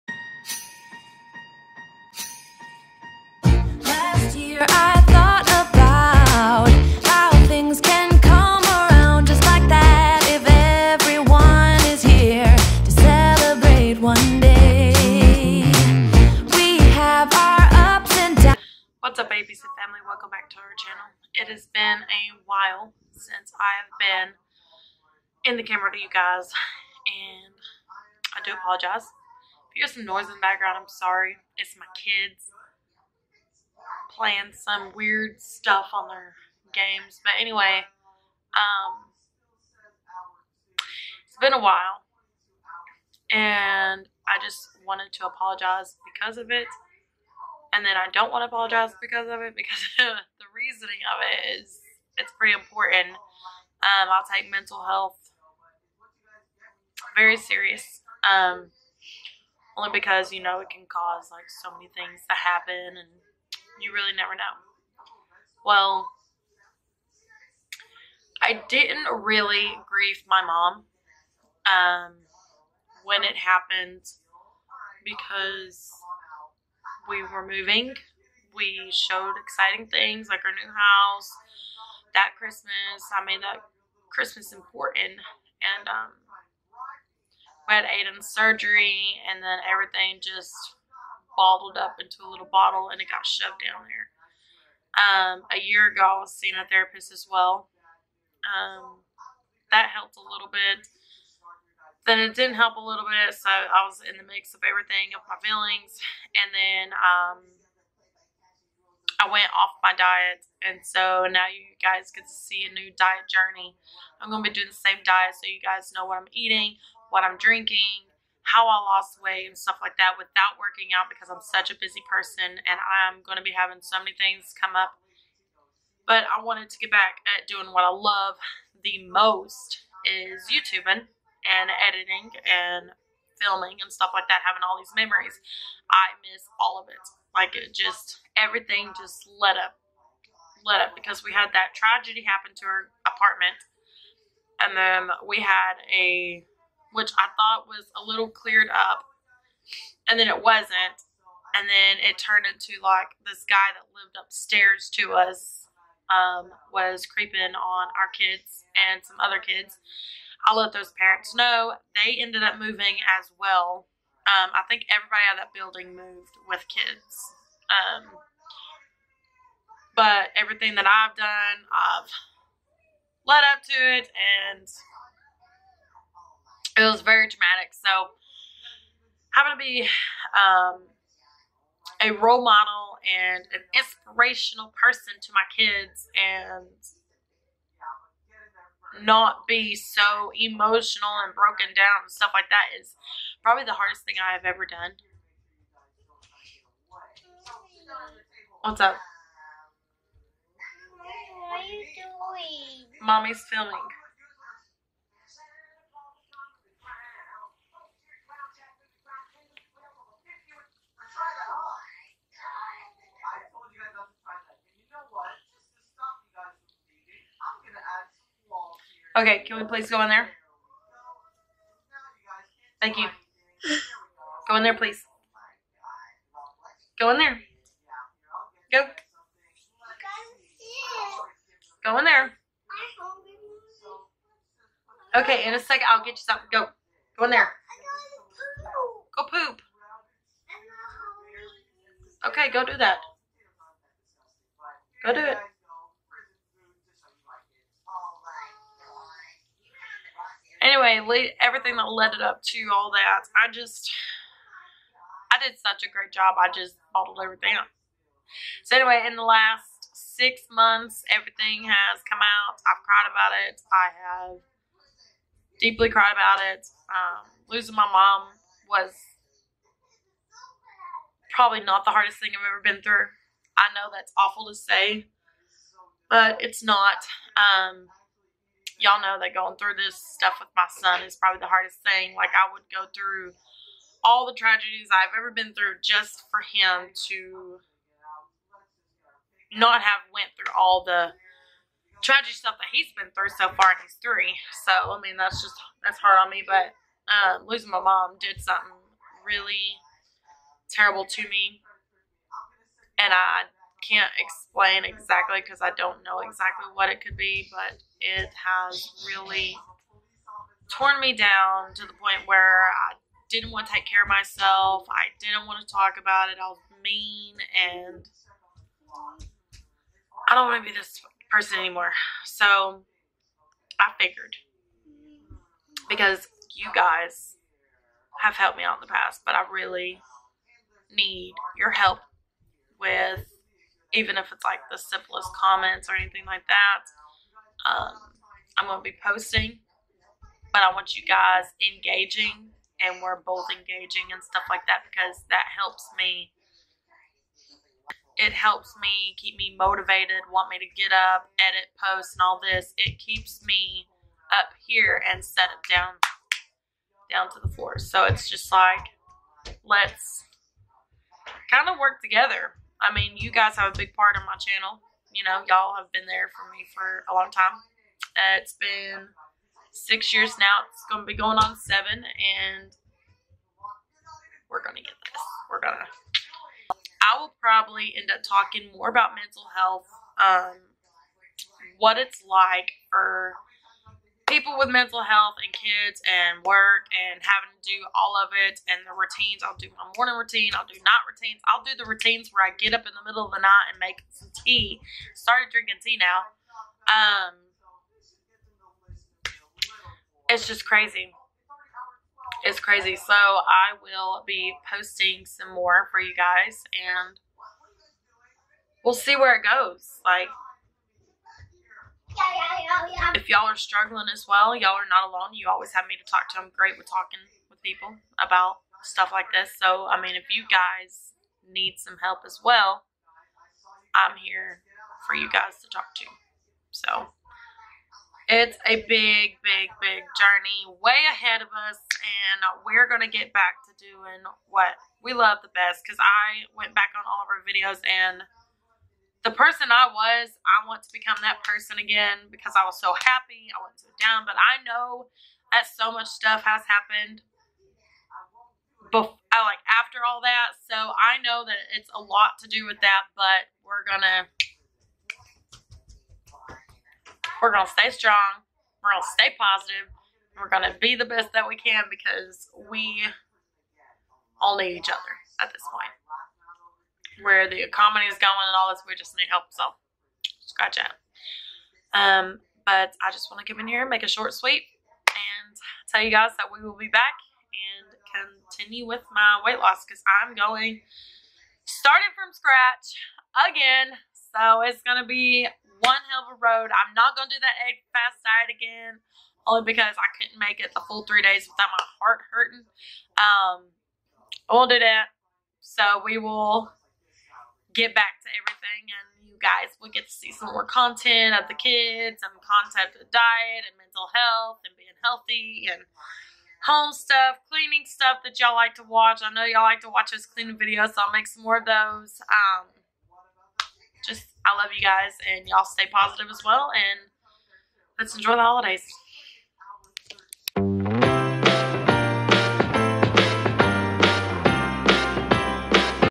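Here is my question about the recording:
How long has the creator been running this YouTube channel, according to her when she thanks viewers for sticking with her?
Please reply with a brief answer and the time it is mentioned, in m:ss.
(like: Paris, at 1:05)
6 years, at 6:09.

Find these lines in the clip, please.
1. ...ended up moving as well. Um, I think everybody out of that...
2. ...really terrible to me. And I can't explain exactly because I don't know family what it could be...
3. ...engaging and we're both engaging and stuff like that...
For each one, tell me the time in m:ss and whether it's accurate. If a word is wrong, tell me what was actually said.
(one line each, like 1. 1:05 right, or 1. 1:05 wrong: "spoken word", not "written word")
1. 2:42 right
2. 4:59 wrong: "exactly", not "family"
3. 5:41 right.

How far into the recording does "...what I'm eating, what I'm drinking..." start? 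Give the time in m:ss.
1:56.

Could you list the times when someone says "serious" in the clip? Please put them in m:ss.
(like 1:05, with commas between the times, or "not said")
0:57.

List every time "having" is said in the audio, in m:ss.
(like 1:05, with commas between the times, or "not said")
2:03, 2:14, 6:27.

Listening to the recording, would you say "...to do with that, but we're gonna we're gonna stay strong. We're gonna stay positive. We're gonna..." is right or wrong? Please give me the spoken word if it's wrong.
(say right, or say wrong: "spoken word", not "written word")
right.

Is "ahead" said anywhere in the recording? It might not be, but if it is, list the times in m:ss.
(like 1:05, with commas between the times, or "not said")
7:11.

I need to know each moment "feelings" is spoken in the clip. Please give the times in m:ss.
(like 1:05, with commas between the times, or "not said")
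1:45.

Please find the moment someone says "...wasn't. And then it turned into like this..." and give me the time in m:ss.
2:30.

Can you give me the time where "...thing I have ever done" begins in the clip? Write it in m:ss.
3:14.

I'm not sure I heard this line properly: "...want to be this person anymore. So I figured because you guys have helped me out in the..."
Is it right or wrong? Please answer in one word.
right.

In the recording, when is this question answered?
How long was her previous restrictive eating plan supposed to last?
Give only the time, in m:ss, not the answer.
8:11.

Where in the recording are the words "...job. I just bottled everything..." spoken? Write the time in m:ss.
4:16.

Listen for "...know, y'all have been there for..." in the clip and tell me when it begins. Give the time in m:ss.
6:05.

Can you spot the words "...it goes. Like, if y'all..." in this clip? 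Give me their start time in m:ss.
6:49.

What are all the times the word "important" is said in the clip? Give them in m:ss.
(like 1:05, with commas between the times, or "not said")
0:52, 1:24.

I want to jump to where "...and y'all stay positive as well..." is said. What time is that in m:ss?
8:35.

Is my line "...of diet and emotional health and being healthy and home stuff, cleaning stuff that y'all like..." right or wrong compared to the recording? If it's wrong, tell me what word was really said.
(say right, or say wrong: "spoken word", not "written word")
wrong: "mental", not "emotional".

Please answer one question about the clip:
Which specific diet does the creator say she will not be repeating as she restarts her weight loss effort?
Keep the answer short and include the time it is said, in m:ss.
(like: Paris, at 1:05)
egg fast diet, at 8:07.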